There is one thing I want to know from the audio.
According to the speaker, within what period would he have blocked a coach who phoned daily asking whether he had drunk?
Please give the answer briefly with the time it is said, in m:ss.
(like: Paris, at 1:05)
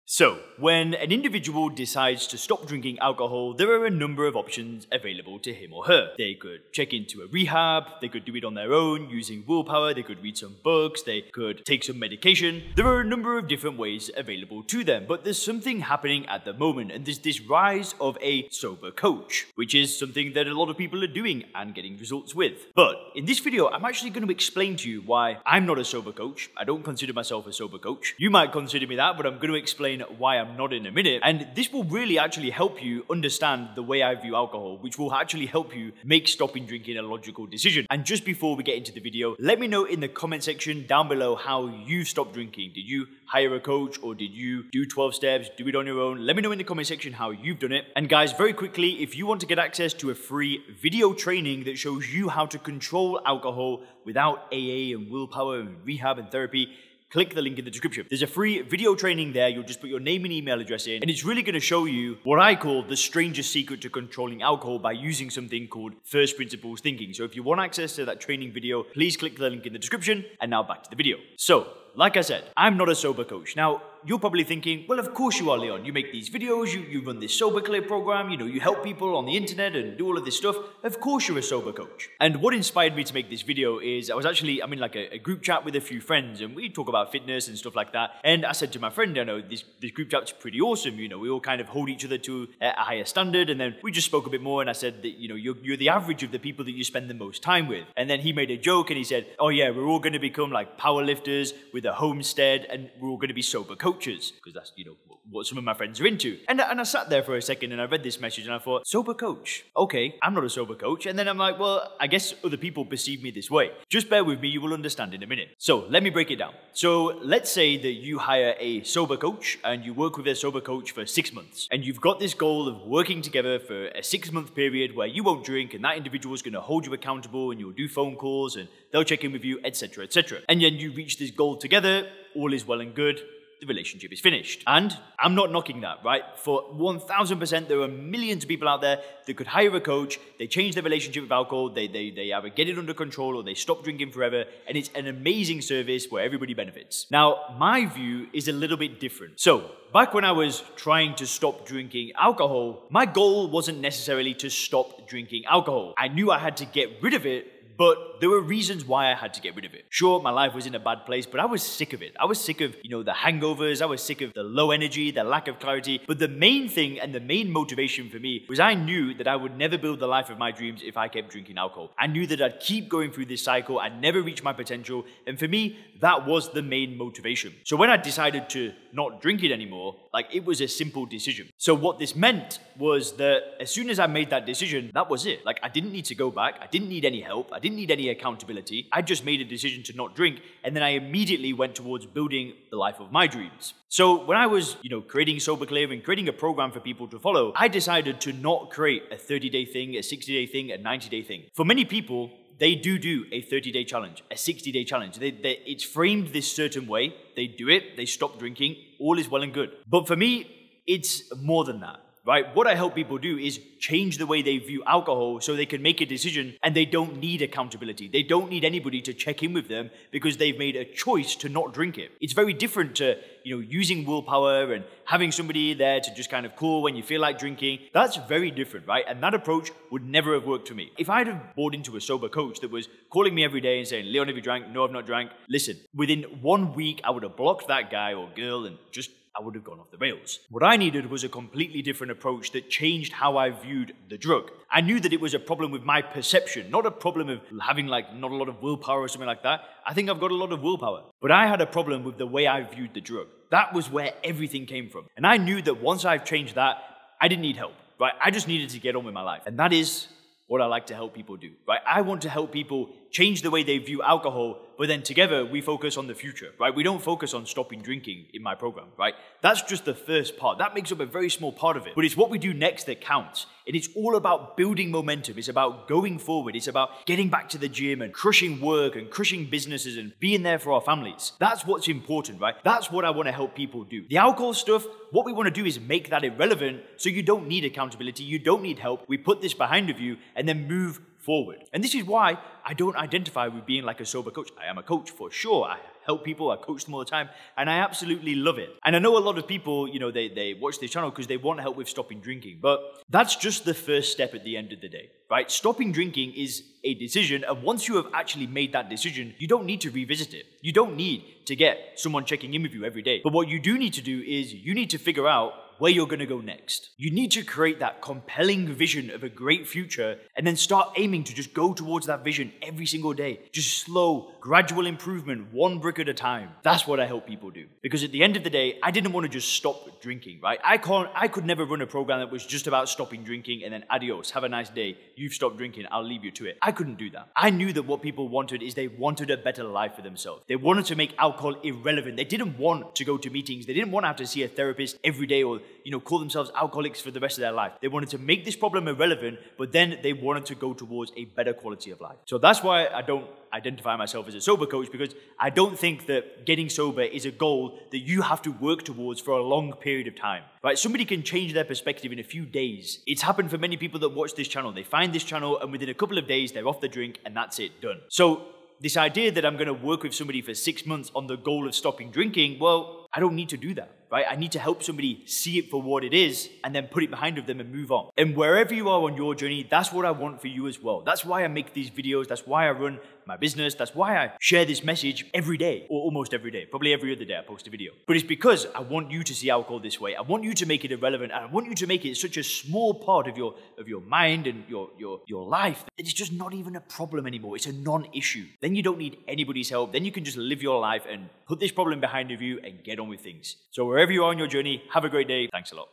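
one week, at 3:56.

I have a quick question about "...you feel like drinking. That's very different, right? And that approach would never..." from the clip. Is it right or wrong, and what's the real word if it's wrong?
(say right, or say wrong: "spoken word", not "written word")
right.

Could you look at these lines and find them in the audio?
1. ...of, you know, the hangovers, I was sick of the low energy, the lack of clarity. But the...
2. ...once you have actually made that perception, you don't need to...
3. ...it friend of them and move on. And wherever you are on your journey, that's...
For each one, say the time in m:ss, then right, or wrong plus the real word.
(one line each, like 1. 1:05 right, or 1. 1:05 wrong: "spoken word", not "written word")
1. 2:42 right
2. 5:07 wrong: "decision", not "perception"
3. 6:17 wrong: "behind", not "friend".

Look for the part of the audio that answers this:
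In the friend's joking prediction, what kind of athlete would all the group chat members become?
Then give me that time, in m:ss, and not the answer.
1:40.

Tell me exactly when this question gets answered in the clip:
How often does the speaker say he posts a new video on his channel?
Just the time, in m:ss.
6:26.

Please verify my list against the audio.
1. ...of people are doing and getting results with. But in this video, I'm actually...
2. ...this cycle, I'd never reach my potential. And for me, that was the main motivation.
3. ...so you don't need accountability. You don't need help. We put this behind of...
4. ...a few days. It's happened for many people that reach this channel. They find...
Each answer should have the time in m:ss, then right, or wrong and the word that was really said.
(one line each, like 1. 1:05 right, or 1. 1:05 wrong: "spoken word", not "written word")
1. 0:20 right
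2. 2:53 right
3. 4:46 right
4. 6:02 wrong: "watch", not "reach".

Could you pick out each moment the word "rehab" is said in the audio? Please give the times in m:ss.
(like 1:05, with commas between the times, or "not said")
0:07, 0:55.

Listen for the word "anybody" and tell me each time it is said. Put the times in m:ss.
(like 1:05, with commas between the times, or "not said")
3:38, 6:39.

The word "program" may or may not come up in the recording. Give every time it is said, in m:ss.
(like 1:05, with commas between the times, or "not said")
1:17, 3:16, 4:28, 5:31.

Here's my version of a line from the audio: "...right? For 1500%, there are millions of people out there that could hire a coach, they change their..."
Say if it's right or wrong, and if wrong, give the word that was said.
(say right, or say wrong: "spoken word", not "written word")
wrong: "1000", not "1500".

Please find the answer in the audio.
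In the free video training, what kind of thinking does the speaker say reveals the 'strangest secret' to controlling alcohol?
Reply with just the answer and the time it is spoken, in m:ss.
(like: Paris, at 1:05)
first principles thinking, at 1:06.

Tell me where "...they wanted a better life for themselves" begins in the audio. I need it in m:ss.
5:38.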